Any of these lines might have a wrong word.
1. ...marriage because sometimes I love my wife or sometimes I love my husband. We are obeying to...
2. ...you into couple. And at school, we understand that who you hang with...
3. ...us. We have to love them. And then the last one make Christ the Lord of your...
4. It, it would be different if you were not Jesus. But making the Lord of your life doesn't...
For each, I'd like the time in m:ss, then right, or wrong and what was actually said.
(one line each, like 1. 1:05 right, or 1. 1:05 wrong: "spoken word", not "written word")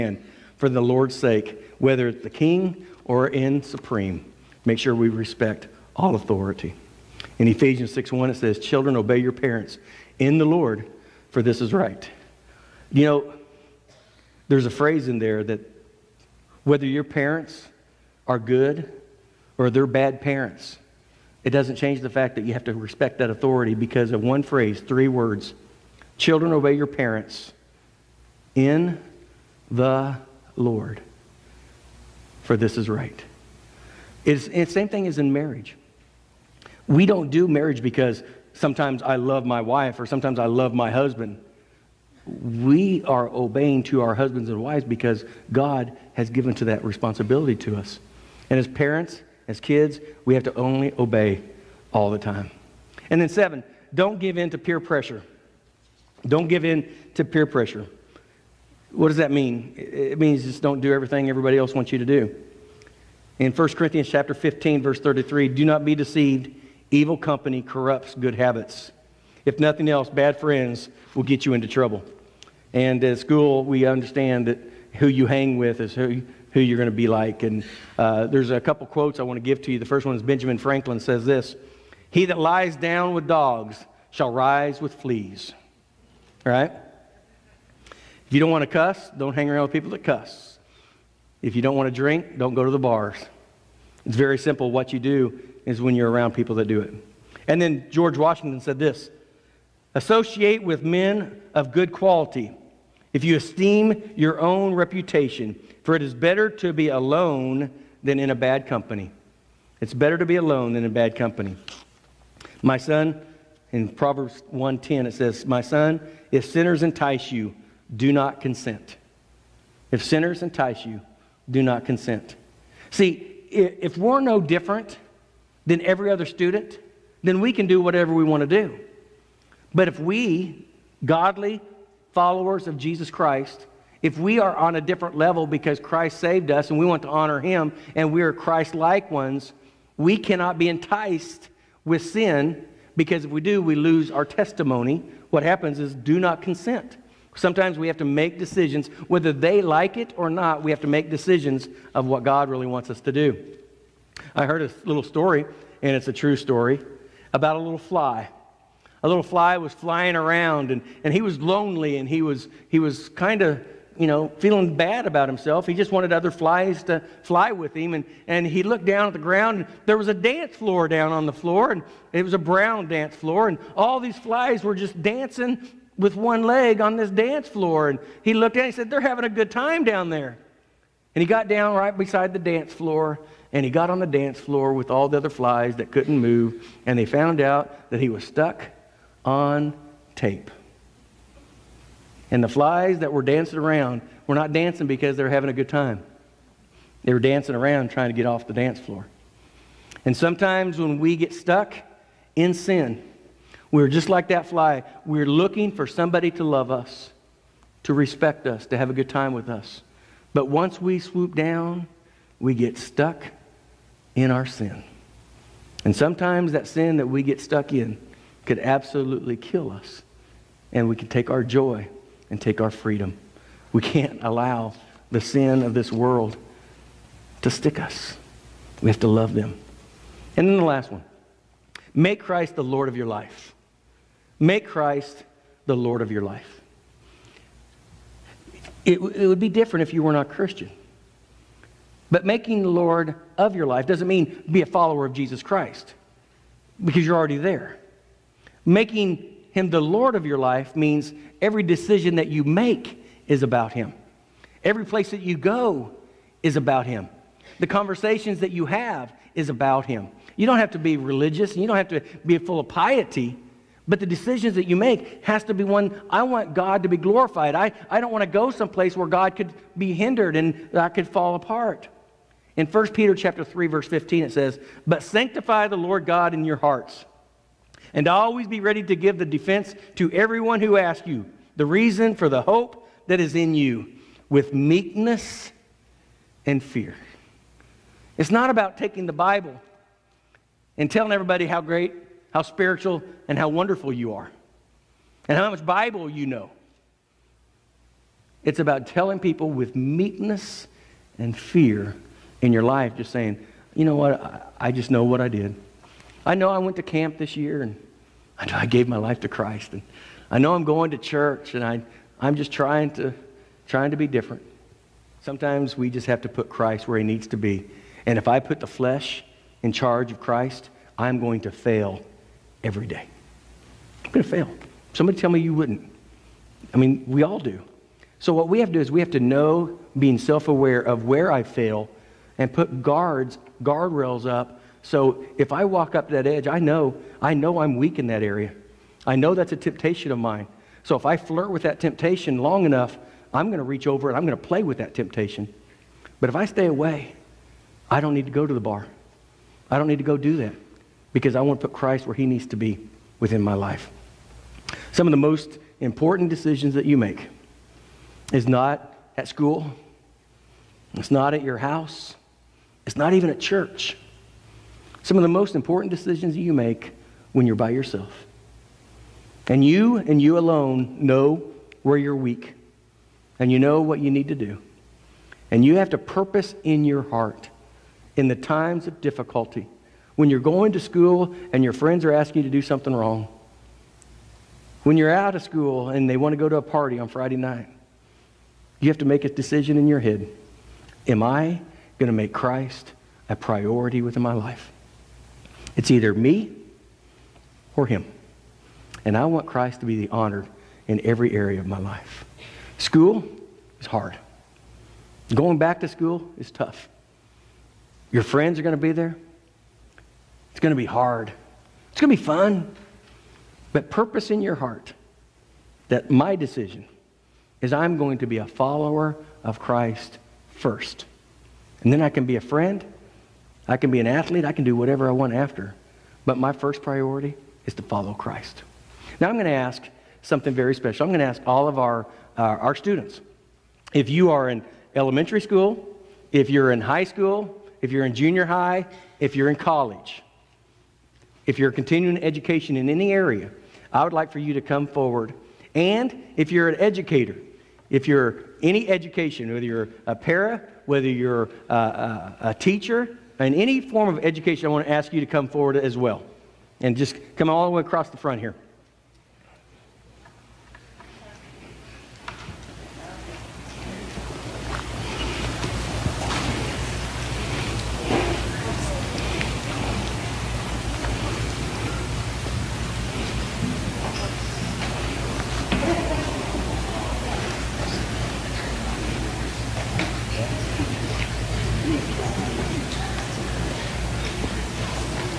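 1. 0:37 right
2. 1:11 wrong: "trouble", not "couple"
3. 3:47 right
4. 3:58 wrong: "Christian", not "Jesus".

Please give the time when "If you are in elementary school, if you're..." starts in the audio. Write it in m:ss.
7:13.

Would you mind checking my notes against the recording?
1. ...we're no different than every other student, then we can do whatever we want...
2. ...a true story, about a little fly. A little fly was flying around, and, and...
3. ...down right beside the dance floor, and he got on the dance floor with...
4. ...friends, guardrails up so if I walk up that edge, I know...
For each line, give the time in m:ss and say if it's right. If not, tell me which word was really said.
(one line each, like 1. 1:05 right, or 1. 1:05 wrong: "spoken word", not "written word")
1. 2:03 right
2. 2:36 right
3. 3:01 right
4. 5:32 wrong: "guards", not "friends".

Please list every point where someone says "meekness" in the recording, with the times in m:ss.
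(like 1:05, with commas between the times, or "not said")
4:44, 4:59.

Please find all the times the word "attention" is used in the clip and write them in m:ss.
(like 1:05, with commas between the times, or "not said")
not said.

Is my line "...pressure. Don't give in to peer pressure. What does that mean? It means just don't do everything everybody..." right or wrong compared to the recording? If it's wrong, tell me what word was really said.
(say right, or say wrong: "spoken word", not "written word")
right.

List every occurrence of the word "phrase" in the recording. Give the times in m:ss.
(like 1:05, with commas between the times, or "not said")
0:14, 0:24.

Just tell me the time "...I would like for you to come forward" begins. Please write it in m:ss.
7:23.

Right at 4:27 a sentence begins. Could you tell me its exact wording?
I, I don't want to go someplace where God could be hindered and I could fall apart.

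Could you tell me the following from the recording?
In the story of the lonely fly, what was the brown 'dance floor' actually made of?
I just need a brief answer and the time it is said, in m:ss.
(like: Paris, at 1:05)
tape, at 3:10.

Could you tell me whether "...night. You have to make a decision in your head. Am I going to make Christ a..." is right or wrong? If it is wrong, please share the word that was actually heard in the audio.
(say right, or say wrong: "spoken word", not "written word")
right.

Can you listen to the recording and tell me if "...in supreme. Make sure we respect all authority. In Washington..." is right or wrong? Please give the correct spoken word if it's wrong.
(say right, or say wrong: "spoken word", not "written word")
wrong: "Ephesians", not "Washington".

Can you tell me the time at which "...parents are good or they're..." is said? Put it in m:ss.
0:17.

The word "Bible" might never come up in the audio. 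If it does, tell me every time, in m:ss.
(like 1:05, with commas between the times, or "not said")
4:49, 4:55.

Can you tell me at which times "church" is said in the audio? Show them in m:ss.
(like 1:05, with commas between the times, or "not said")
5:10, 6:03.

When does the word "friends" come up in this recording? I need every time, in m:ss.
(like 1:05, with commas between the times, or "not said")
1:10, 6:21, 6:48, 7:02.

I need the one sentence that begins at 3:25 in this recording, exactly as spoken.
We're looking for somebody to love us, to respect us, to have a good time with us.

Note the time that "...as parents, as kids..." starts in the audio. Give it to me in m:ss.
0:48.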